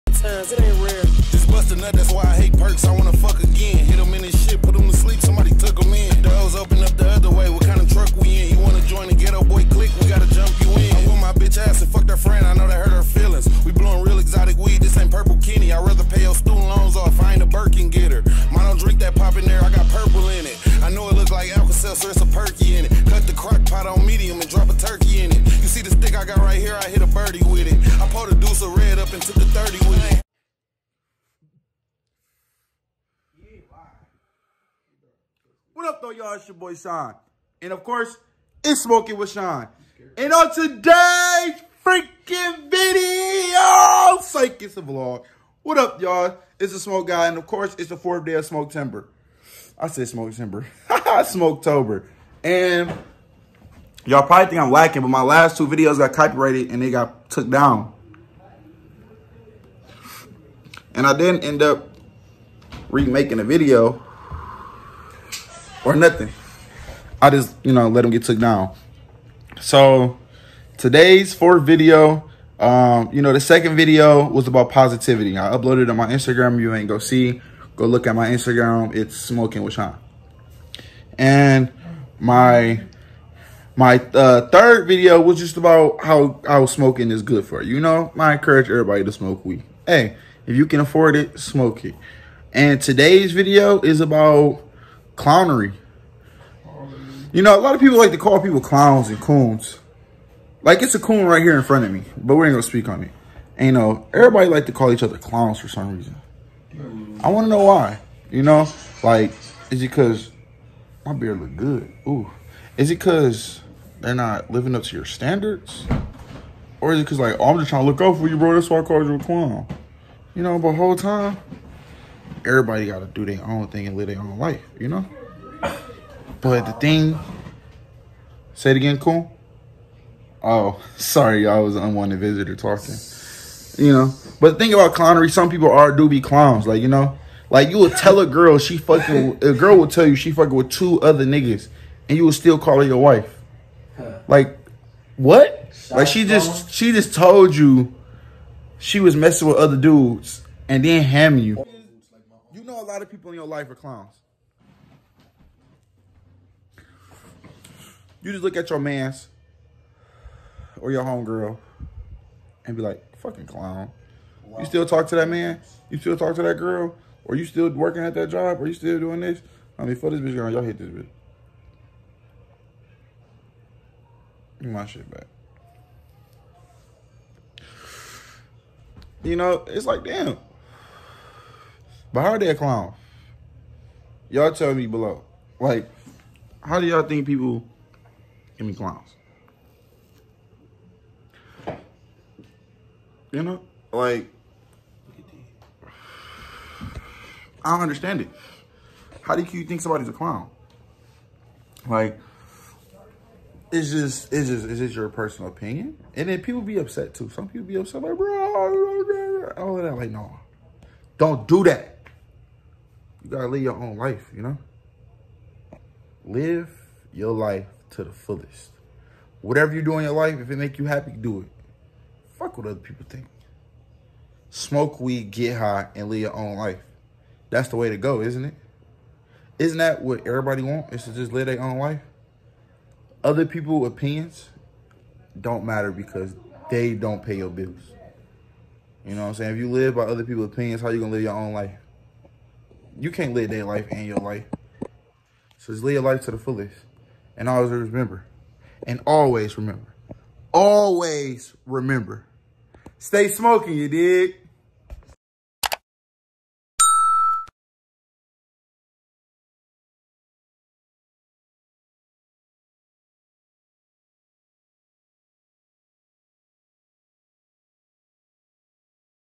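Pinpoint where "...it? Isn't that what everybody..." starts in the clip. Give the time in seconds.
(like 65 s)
228 s.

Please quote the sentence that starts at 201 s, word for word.
Like, it's just, it's just, it's just your personal opinion.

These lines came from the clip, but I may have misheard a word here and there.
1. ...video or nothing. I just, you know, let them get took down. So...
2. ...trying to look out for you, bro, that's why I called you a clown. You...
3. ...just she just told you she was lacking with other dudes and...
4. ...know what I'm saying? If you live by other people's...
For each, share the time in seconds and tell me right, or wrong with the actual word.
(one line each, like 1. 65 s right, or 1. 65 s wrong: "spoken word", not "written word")
1. 63 s right
2. 117 s right
3. 146 s wrong: "messing", not "lacking"
4. 239 s right.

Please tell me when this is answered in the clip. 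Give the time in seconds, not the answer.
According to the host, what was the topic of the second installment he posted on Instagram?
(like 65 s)
74 s.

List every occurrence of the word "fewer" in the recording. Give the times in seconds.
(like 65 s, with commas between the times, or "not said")
not said.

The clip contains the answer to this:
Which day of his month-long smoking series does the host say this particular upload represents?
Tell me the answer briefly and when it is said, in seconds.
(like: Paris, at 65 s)
4th day, at 47 s.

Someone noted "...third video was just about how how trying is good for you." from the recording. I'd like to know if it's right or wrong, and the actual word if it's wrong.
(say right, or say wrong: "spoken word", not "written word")
wrong: "smoking", not "trying".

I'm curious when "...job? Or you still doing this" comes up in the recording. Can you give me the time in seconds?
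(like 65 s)
168 s.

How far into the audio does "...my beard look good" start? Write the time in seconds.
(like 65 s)
111 s.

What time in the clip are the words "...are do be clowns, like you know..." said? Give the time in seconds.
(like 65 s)
135 s.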